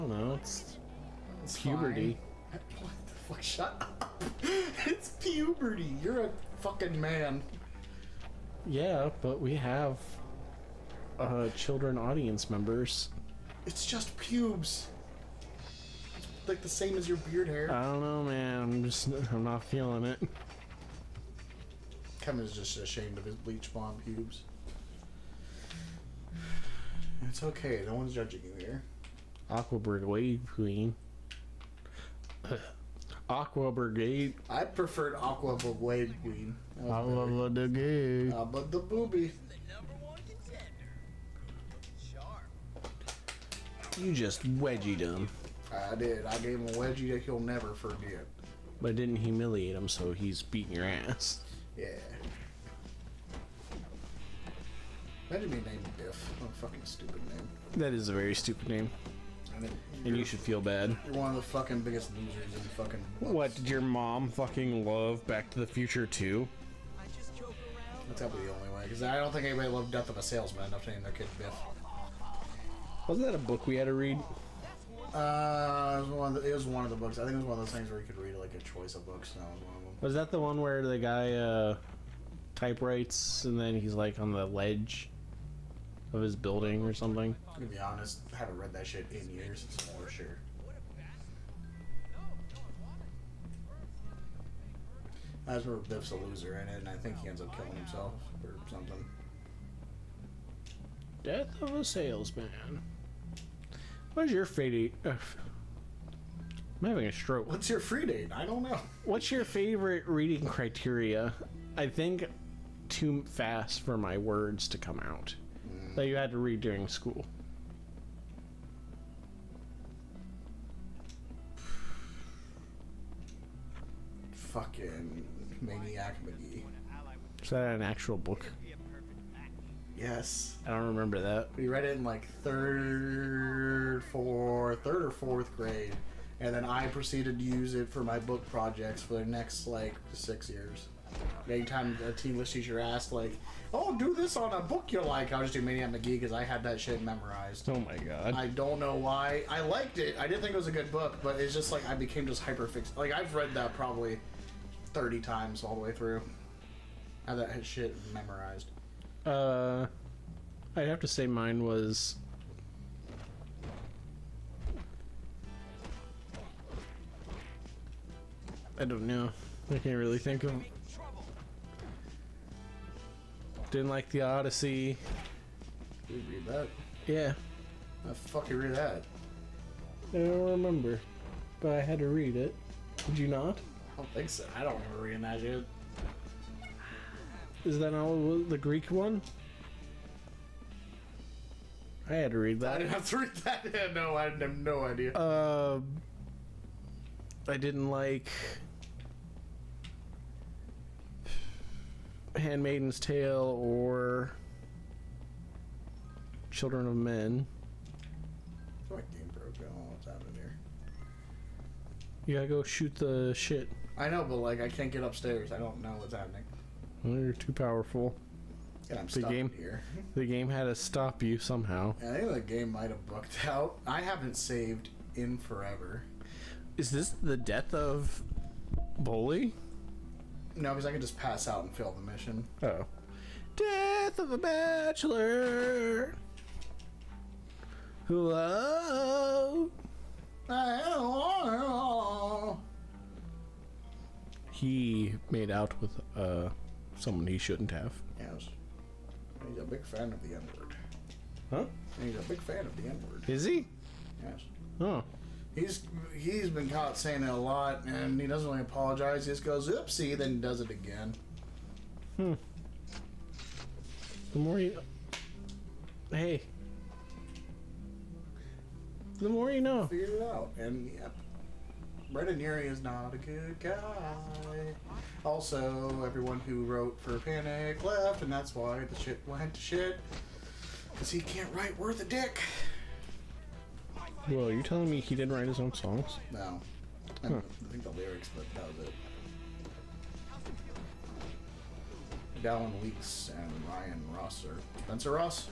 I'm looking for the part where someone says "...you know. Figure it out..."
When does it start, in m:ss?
4:29.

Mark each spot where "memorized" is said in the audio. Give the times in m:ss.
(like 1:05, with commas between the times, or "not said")
2:27, 2:38.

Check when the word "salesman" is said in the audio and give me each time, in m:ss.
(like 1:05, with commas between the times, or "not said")
1:10, 1:41.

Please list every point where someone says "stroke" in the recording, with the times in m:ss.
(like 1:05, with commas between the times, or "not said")
1:47.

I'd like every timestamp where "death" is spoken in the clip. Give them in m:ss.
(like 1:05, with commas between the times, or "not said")
1:09, 1:41, 3:47, 3:53.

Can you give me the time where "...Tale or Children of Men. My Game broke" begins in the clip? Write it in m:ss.
3:23.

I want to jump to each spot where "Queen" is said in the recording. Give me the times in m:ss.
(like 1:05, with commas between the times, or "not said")
0:30, 0:36.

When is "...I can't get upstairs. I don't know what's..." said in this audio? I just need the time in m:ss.
3:34.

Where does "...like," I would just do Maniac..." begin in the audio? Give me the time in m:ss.
2:25.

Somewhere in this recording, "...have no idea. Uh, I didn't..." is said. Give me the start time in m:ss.
3:14.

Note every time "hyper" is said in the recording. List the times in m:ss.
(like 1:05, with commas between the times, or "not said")
2:32.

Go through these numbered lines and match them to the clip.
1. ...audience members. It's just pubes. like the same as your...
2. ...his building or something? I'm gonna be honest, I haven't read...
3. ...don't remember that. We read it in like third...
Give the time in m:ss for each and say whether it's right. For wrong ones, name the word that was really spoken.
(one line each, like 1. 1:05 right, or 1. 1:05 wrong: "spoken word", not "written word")
1. 0:11 right
2. 1:26 right
3. 2:10 right.